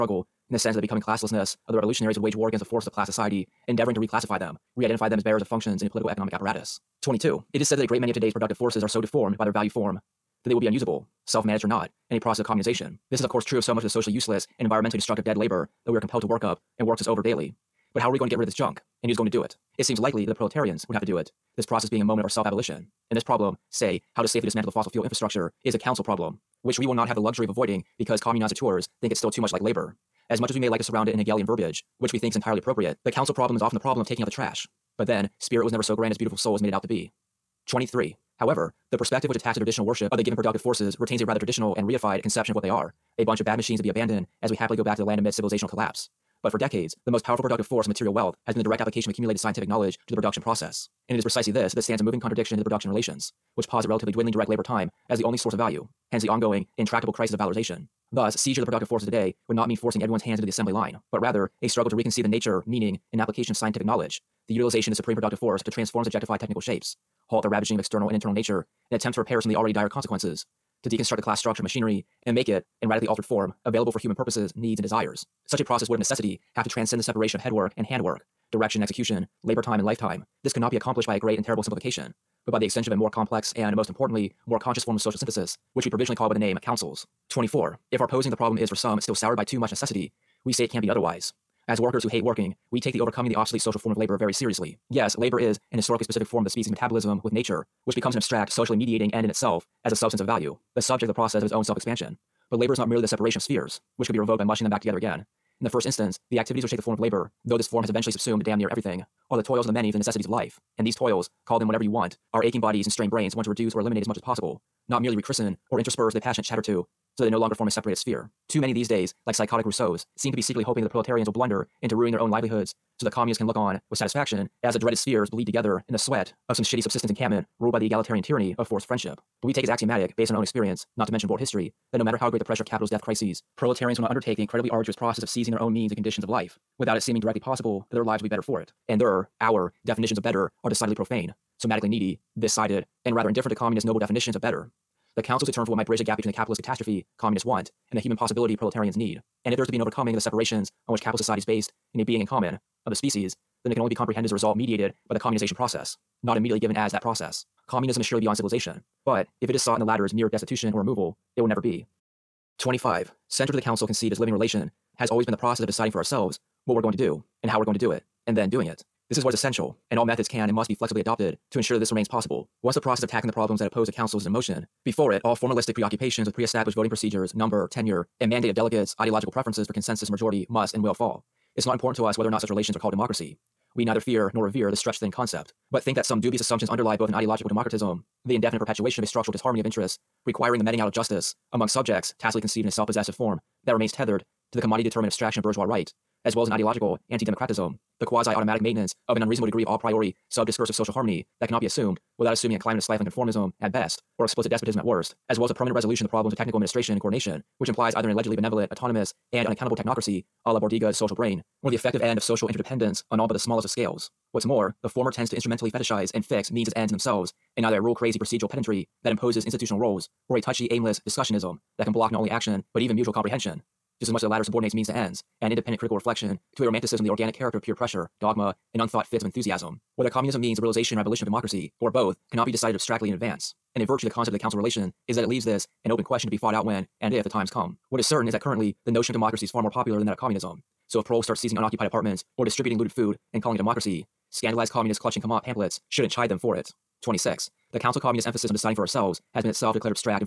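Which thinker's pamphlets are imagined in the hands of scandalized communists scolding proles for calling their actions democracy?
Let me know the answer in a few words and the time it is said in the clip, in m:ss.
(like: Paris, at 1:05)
Camatte, at 4:05.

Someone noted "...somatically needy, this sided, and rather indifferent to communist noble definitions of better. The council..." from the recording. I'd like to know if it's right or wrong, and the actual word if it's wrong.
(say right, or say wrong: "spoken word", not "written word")
right.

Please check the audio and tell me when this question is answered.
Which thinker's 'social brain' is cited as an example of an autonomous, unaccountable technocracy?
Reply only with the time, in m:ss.
3:30.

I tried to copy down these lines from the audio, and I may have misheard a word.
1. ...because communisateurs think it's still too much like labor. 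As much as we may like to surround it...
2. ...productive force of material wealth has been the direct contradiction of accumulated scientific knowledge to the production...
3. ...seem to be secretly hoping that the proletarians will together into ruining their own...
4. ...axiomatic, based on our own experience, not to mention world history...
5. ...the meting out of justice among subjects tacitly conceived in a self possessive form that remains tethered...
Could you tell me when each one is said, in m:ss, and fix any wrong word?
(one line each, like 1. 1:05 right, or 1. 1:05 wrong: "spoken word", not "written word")
1. 0:27 right
2. 0:47 wrong: "application", not "contradiction"
3. 2:00 wrong: "blunder", not "together"
4. 2:09 right
5. 3:10 right.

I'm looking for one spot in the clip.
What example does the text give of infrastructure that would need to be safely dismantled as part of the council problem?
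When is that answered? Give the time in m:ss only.
0:24.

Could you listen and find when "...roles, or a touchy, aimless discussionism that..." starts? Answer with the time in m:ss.
3:39.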